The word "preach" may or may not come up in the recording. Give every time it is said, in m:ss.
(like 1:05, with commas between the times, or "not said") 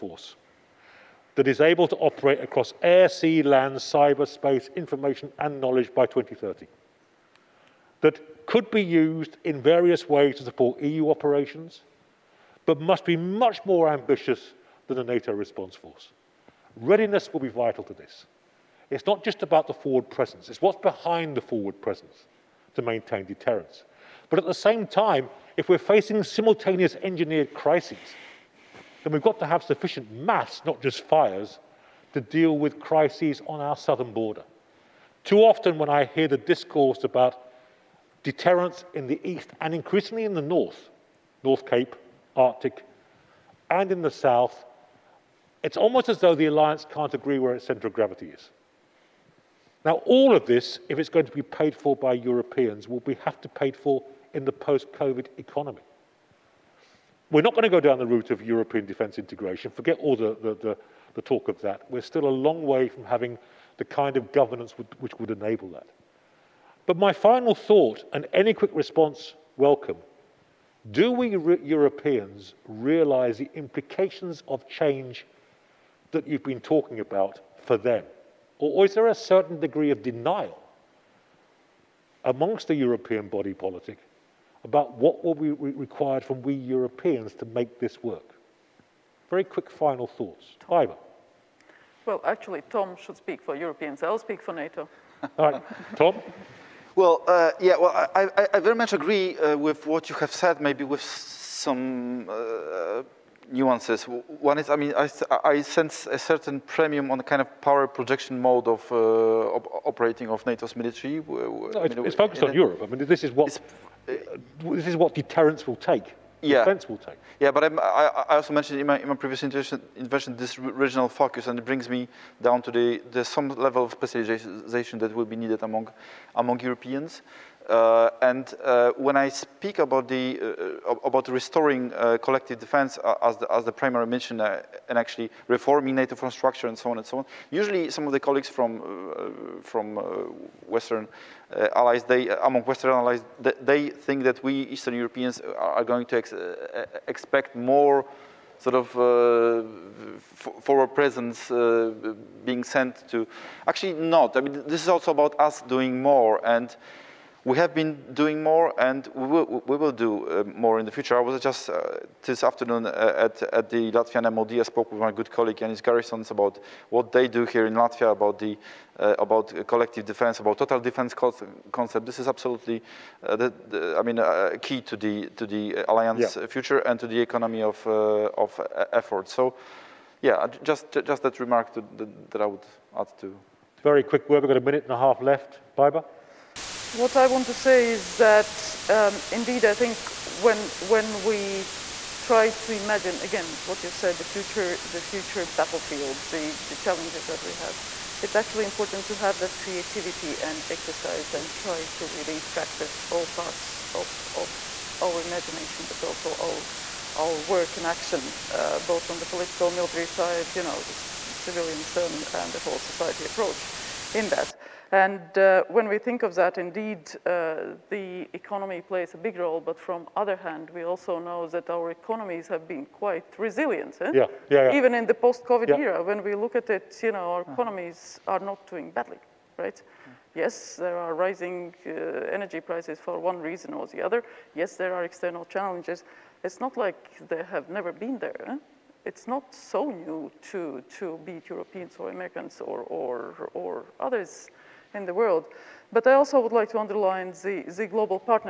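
not said.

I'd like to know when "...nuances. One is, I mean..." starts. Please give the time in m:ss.
1:43.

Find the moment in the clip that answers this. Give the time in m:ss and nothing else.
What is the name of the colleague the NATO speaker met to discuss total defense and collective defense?
2:45.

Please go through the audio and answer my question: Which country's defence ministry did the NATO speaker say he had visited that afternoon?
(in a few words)
Latvia.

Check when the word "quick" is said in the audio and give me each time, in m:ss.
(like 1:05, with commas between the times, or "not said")
1:08, 1:29, 3:04.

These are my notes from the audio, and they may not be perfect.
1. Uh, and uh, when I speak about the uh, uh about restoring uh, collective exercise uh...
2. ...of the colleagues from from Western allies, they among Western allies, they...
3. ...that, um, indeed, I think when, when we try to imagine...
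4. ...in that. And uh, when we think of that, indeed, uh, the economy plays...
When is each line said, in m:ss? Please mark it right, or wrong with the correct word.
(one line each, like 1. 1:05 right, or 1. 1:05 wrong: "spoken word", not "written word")
1. 2:07 wrong: "defense", not "exercise"
2. 2:18 right
3. 3:08 right
4. 3:34 right.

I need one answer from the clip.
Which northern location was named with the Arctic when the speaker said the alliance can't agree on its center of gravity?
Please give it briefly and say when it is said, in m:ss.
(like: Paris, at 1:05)
North Cape, at 0:41.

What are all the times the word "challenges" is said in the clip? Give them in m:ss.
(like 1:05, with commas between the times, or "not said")
3:16, 3:55.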